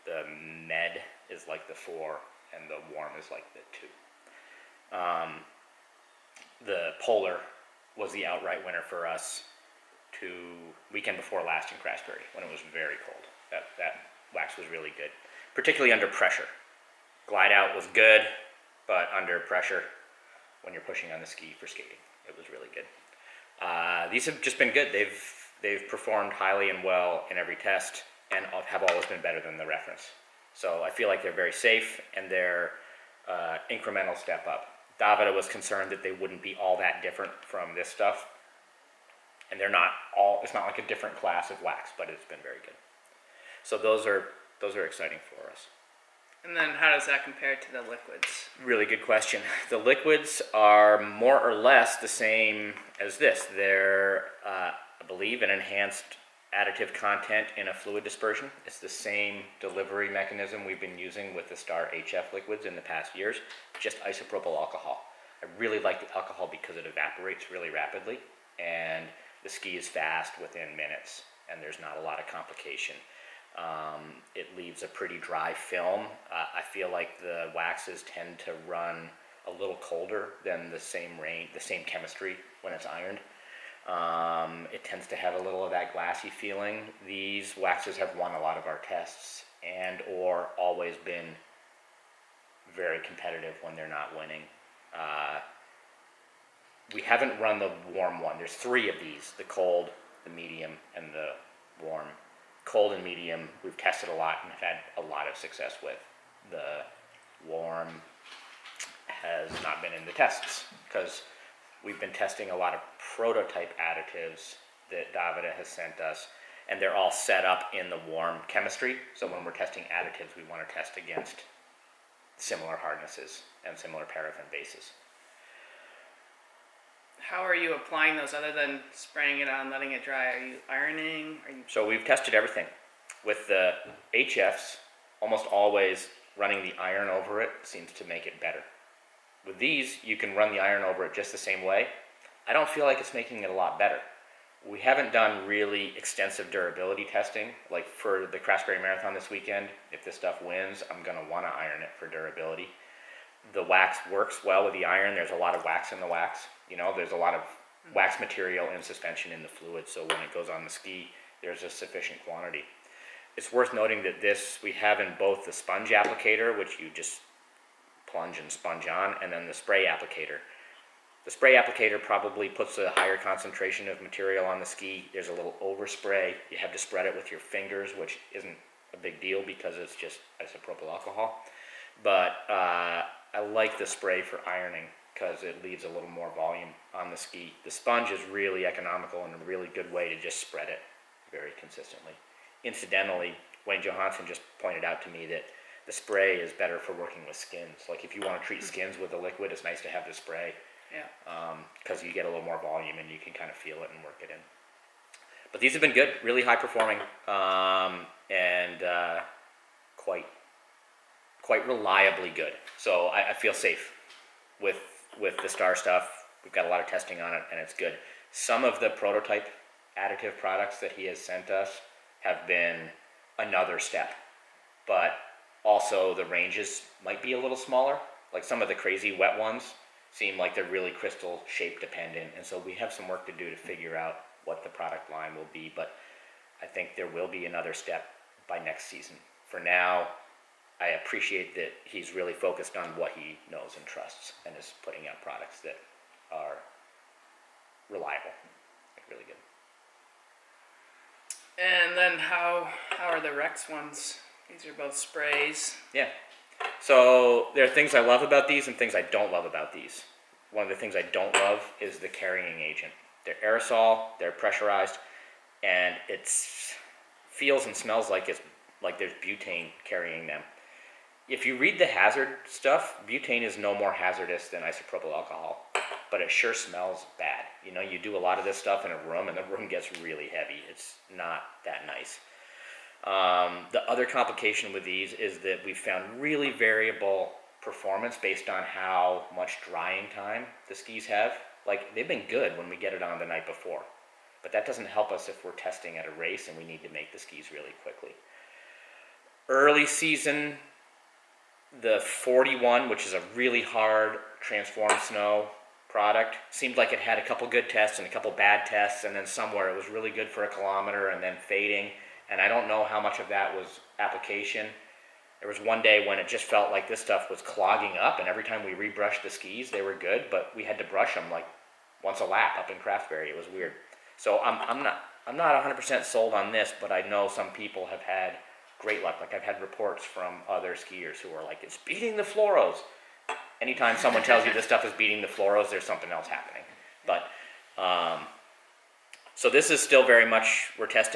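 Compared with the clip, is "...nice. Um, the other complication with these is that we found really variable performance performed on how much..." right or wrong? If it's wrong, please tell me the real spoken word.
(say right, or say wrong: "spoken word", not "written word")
wrong: "based", not "performed".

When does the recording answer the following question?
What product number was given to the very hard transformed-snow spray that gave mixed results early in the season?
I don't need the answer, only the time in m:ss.
5:02.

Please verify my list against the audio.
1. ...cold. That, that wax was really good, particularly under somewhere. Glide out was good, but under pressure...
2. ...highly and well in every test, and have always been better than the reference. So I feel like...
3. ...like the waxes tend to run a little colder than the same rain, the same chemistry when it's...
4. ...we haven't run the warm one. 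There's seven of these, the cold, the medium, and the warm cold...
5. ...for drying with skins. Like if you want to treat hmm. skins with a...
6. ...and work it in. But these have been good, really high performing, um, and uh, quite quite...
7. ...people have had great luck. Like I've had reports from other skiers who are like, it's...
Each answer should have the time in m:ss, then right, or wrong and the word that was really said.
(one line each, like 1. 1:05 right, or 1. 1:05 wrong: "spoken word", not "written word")
1. 0:13 wrong: "pressure", not "somewhere"
2. 0:26 right
3. 1:16 right
4. 1:36 wrong: "three", not "seven"
5. 3:16 wrong: "working", not "drying"
6. 3:23 right
7. 5:27 right.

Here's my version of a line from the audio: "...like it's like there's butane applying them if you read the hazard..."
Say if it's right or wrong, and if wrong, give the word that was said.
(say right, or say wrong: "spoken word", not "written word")
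wrong: "carrying", not "applying".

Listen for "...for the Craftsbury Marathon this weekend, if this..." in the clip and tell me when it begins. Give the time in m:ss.
2:27.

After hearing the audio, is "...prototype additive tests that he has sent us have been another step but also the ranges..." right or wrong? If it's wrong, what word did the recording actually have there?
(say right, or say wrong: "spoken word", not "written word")
wrong: "products", not "tests".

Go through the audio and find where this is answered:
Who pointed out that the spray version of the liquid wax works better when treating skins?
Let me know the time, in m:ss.
3:13.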